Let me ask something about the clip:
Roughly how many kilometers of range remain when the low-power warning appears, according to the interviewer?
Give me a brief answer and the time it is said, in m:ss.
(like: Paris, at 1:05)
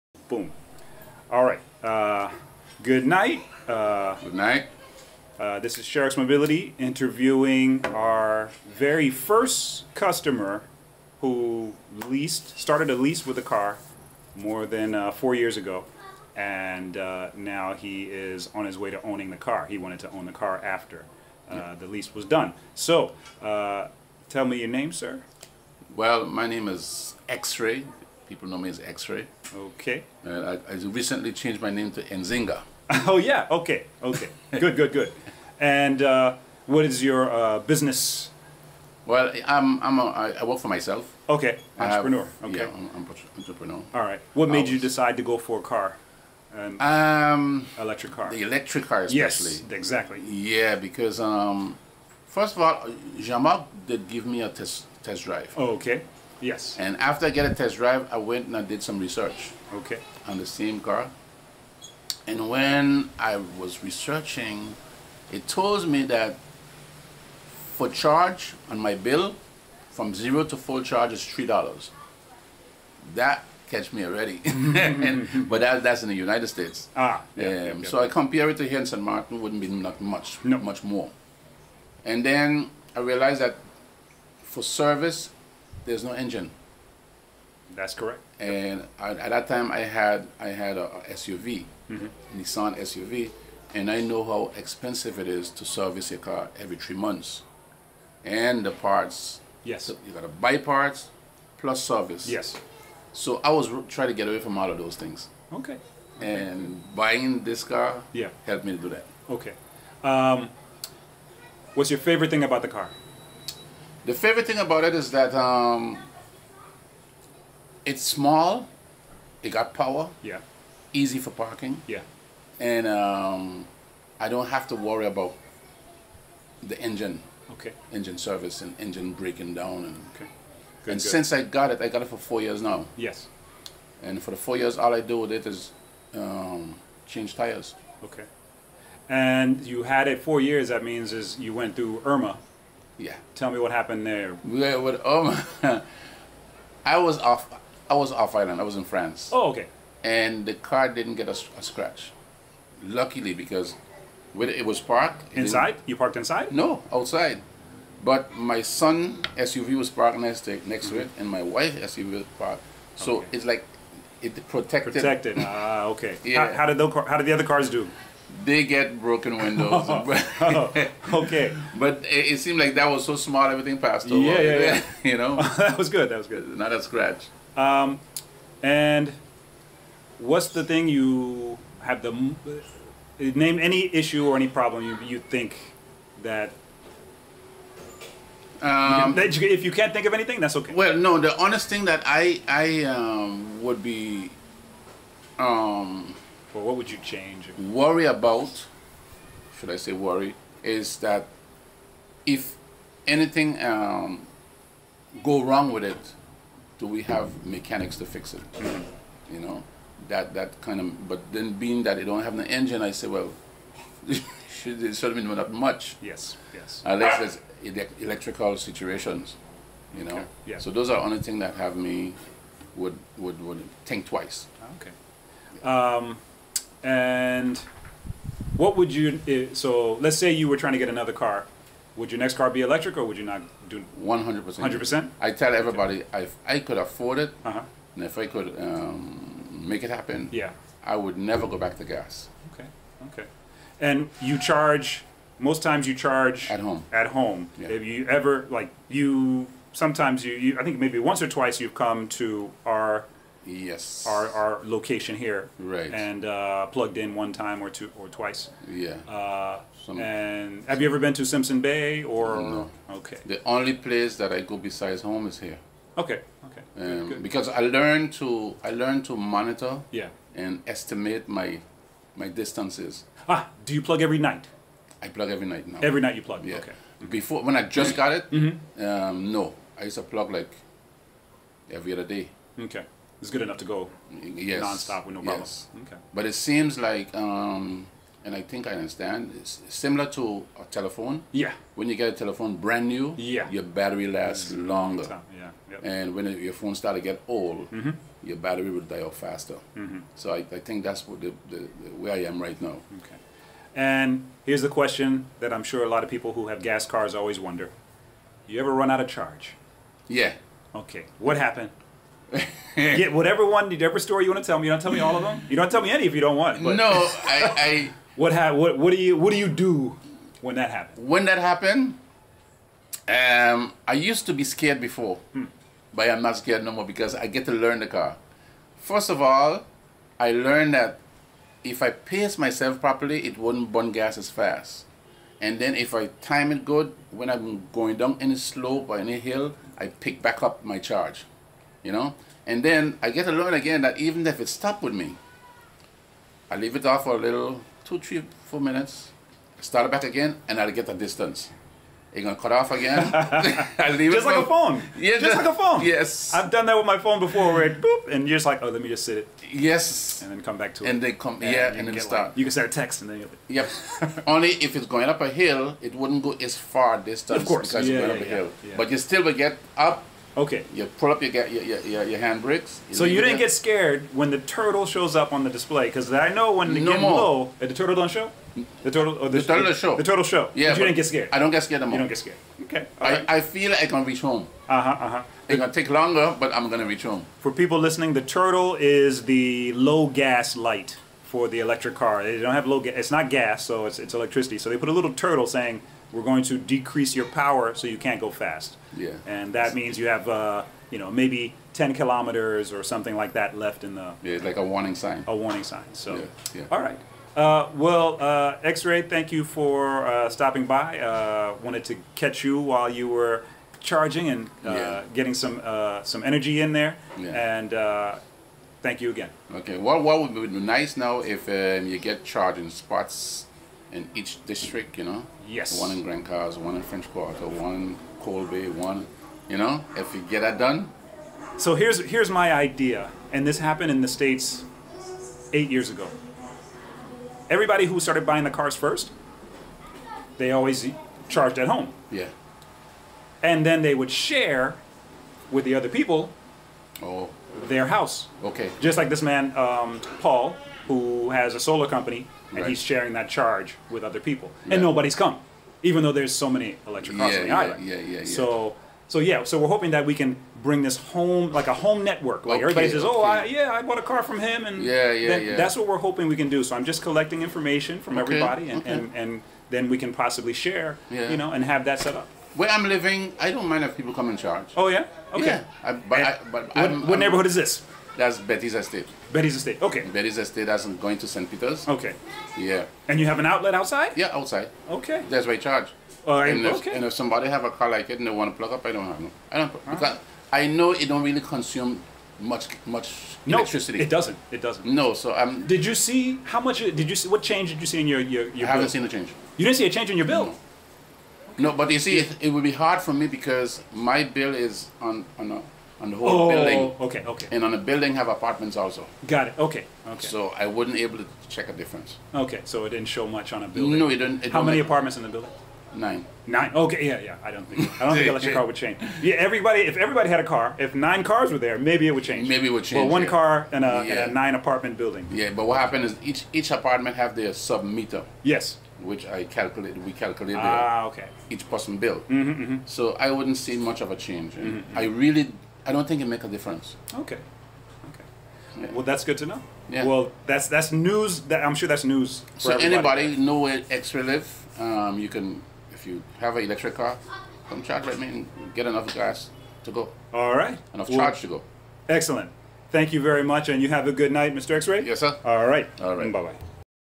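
10 kilometers, at 6:41.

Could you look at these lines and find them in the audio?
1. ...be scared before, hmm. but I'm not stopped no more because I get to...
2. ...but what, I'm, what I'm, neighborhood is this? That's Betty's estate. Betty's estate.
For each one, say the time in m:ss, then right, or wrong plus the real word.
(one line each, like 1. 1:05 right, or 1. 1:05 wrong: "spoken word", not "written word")
1. 5:24 wrong: "scared", not "stopped"
2. 7:56 right.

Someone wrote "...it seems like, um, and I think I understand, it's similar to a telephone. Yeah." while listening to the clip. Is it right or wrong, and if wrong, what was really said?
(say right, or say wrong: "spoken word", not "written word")
right.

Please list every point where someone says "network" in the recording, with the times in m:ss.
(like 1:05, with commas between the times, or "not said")
7:42.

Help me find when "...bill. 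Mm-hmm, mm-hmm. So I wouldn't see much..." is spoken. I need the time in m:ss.
8:51.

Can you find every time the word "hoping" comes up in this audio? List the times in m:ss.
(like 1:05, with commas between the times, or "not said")
7:39, 7:45.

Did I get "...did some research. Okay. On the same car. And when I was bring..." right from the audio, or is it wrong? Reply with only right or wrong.
wrong.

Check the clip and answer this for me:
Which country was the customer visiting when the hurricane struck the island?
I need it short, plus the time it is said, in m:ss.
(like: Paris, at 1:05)
France, at 2:28.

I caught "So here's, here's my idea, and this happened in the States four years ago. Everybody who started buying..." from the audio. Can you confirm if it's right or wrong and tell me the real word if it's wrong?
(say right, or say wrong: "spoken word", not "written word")
wrong: "eight", not "four".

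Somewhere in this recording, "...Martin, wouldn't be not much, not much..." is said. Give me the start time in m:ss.
1:19.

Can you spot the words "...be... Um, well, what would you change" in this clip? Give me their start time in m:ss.
3:13.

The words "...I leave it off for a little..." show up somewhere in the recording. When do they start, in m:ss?
5:46.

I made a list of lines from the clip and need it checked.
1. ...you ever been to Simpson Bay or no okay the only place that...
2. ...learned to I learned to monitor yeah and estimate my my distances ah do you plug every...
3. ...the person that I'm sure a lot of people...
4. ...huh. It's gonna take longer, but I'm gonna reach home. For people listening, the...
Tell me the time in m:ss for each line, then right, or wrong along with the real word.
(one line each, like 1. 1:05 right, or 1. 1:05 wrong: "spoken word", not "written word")
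1. 4:20 right
2. 4:27 right
3. 5:04 wrong: "question", not "person"
4. 6:25 right.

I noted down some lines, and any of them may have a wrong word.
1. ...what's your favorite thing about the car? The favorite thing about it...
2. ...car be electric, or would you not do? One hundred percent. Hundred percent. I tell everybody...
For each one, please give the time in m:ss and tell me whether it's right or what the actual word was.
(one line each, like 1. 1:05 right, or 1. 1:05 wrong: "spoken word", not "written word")
1. 1:51 right
2. 3:52 right.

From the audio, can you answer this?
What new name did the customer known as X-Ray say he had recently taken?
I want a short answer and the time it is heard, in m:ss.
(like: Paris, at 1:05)
Nzinga, at 0:32.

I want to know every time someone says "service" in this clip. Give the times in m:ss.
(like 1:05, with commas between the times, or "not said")
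1:24, 1:35, 1:41, 2:08.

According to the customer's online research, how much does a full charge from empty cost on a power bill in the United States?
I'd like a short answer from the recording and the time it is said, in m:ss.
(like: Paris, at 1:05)
$3, at 1:11.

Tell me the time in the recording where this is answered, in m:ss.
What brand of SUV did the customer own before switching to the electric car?
1:32.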